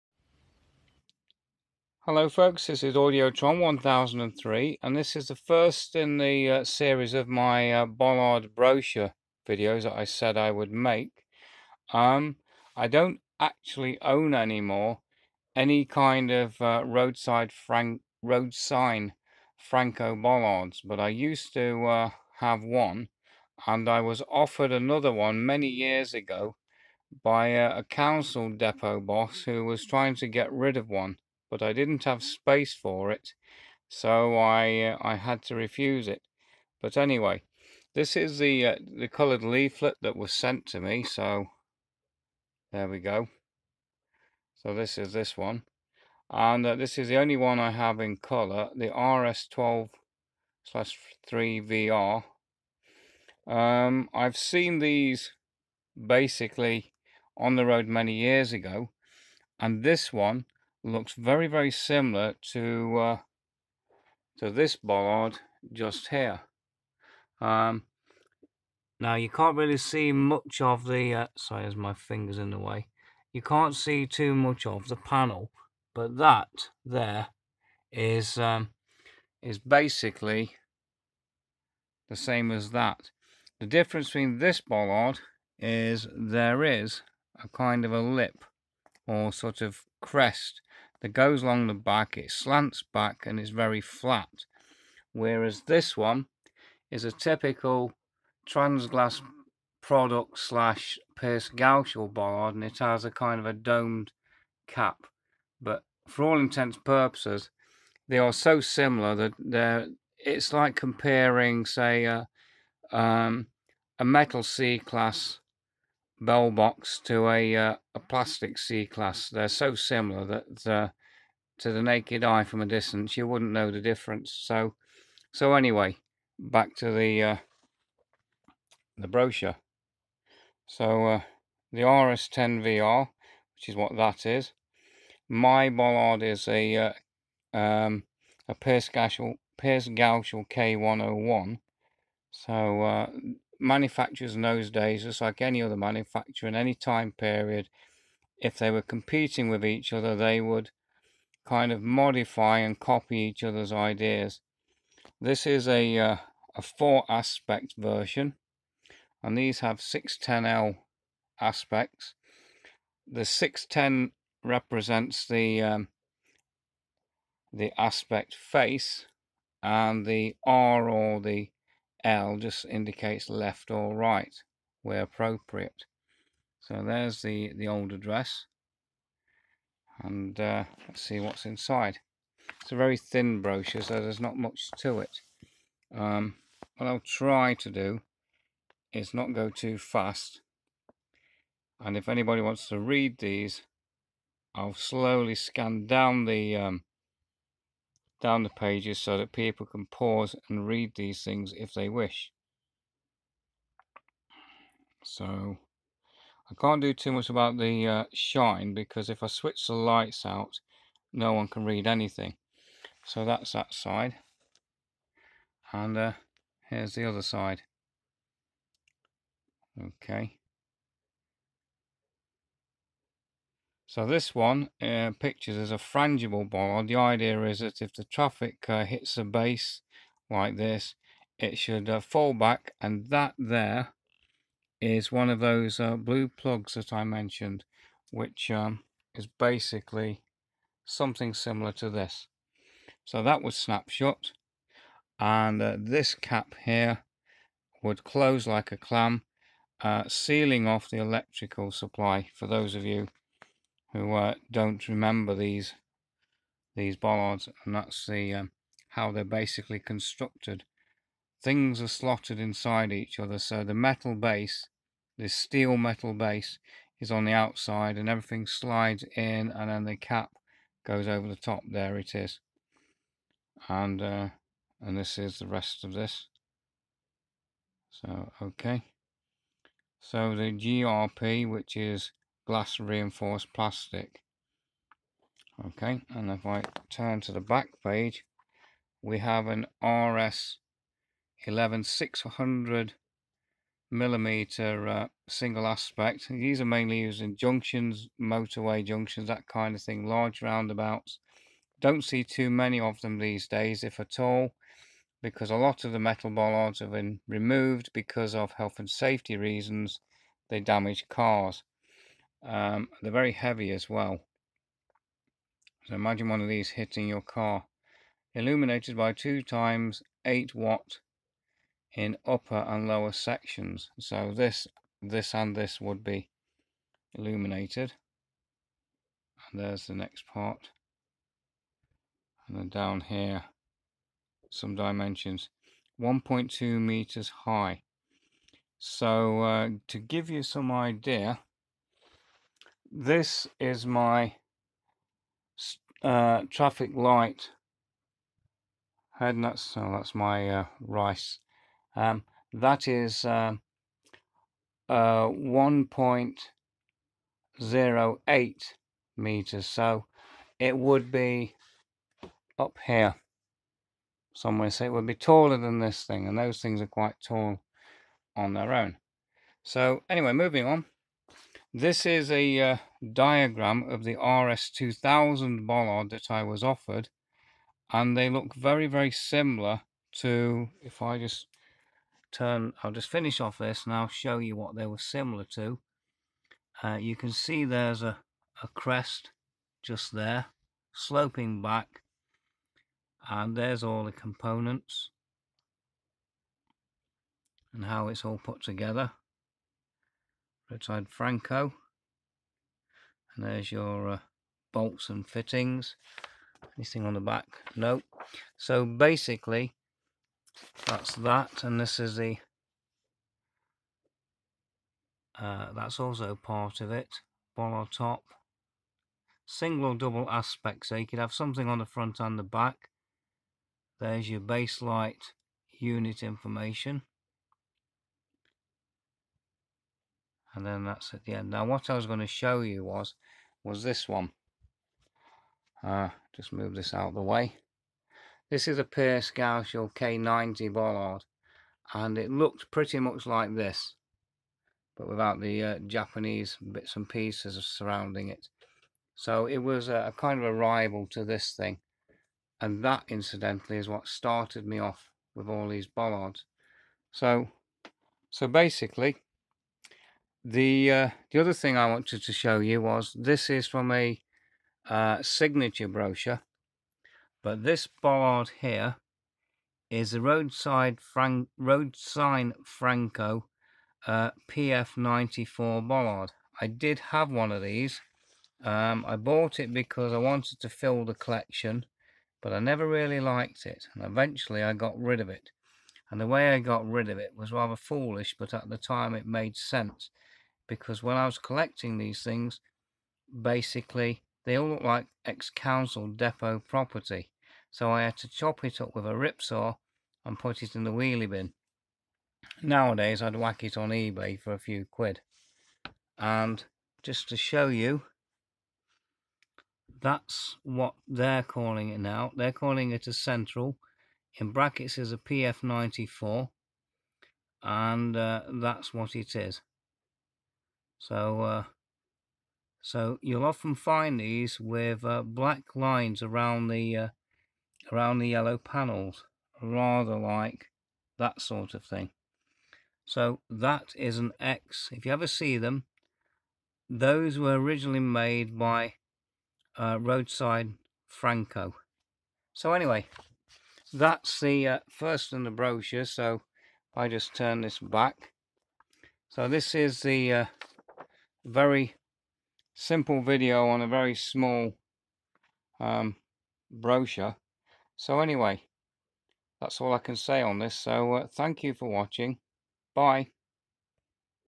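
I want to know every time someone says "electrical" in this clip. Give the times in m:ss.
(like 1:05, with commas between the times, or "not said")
4:11.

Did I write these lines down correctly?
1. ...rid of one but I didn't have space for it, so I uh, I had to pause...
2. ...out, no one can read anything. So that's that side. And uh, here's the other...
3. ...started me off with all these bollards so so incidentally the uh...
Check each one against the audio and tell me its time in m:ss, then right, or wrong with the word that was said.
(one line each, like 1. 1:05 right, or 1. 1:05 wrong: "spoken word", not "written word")
1. 0:30 wrong: "refuse", not "pause"
2. 3:30 right
3. 7:34 wrong: "basically", not "incidentally".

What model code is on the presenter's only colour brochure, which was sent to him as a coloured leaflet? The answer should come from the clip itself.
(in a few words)
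RS12/3VR.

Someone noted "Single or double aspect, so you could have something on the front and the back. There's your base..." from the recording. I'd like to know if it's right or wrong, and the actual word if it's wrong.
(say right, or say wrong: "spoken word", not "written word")
right.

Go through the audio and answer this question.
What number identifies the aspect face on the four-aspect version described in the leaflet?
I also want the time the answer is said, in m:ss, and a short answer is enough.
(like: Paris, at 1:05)
610, at 2:43.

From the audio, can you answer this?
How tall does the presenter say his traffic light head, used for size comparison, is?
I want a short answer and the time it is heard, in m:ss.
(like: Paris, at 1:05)
1.08 metres, at 5:55.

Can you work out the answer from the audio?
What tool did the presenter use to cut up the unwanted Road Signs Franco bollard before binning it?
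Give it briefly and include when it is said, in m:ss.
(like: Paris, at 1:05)
Rip saw, at 8:19.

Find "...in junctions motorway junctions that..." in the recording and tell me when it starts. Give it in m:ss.
4:57.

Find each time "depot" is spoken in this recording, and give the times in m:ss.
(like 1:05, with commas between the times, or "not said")
0:28, 8:16.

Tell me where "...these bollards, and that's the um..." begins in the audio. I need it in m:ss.
4:16.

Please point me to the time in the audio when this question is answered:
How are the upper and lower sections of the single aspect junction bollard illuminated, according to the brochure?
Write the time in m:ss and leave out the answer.
5:19.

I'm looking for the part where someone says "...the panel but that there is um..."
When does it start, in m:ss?
1:14.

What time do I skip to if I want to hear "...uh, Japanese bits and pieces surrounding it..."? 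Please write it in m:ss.
7:25.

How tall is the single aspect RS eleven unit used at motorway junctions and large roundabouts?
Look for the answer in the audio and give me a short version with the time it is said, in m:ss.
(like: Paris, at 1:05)
600 millimetres, at 4:51.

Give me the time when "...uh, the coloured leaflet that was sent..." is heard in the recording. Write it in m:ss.
0:38.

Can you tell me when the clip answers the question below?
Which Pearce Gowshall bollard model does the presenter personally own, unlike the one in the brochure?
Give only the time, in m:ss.
2:20.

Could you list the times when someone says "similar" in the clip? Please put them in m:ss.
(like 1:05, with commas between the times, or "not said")
1:01, 1:48, 1:59, 4:01, 6:19, 6:24.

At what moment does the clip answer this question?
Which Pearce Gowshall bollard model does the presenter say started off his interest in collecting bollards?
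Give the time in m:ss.
7:19.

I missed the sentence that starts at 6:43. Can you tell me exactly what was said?
And there's your uh, bolts and fittings.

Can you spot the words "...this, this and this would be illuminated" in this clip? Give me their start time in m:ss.
5:24.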